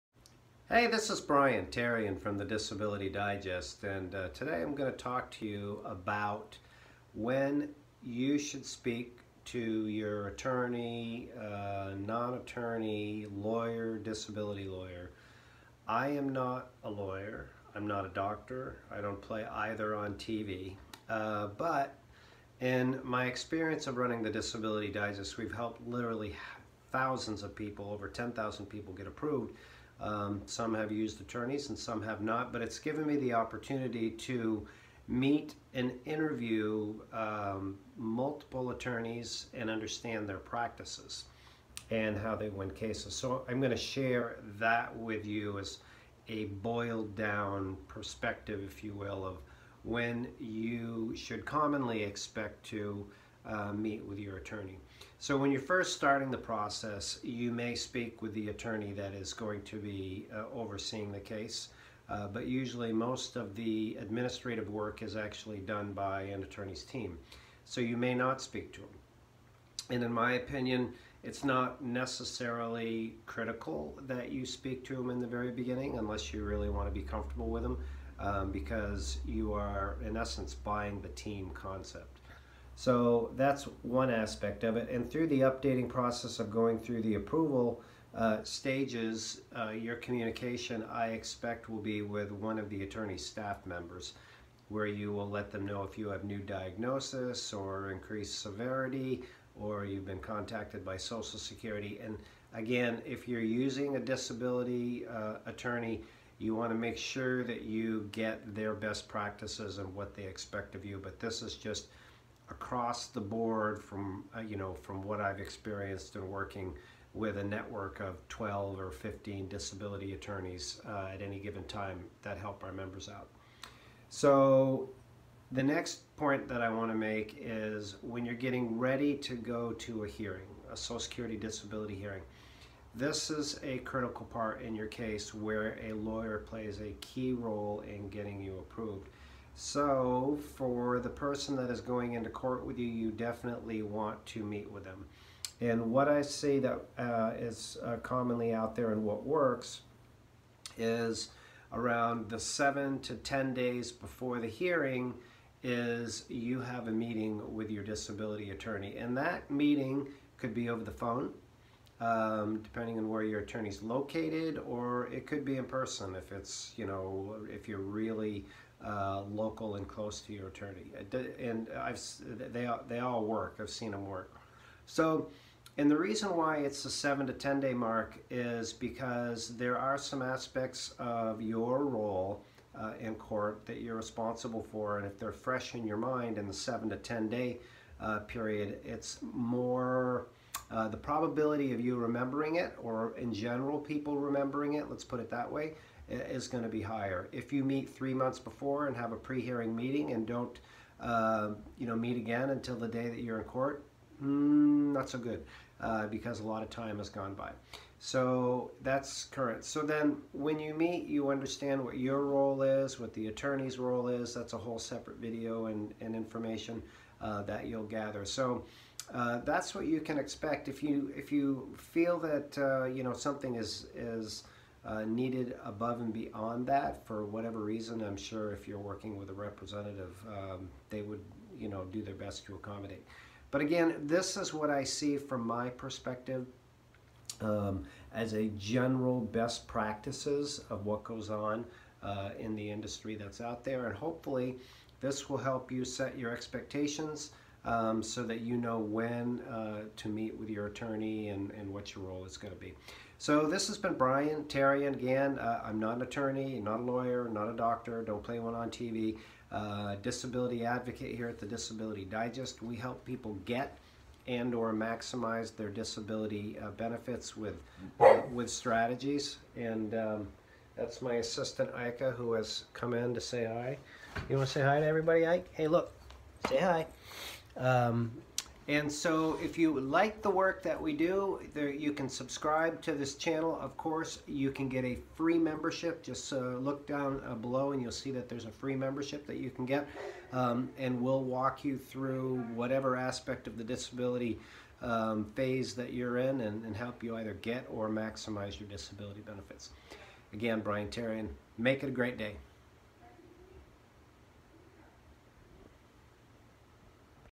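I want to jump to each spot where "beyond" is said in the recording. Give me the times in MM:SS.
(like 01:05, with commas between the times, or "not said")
03:46.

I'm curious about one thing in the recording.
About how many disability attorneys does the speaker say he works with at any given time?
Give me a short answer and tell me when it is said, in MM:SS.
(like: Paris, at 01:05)
12 or 15, at 01:58.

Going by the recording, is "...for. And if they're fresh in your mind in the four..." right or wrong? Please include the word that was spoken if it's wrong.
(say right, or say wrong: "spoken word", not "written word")
wrong: "seven", not "four".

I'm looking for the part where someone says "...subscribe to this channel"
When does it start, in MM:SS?
04:42.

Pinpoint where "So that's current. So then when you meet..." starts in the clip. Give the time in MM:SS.
03:27.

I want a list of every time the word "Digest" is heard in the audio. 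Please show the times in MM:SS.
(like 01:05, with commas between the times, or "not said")
00:03, 00:24, 04:22.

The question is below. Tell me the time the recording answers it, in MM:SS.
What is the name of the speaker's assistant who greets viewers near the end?
04:31.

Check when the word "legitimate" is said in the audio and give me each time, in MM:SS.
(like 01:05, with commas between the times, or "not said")
not said.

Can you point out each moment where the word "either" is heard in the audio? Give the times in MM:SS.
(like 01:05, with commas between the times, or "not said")
00:19, 04:57.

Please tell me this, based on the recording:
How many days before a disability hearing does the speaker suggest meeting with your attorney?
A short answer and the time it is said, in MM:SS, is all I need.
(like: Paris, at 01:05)
7 to 10 days, at 02:32.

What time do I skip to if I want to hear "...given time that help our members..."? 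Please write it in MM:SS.
02:01.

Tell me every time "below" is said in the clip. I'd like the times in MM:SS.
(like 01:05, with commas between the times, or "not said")
04:47.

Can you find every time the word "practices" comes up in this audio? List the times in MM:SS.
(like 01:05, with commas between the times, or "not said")
00:40, 01:49, 03:59.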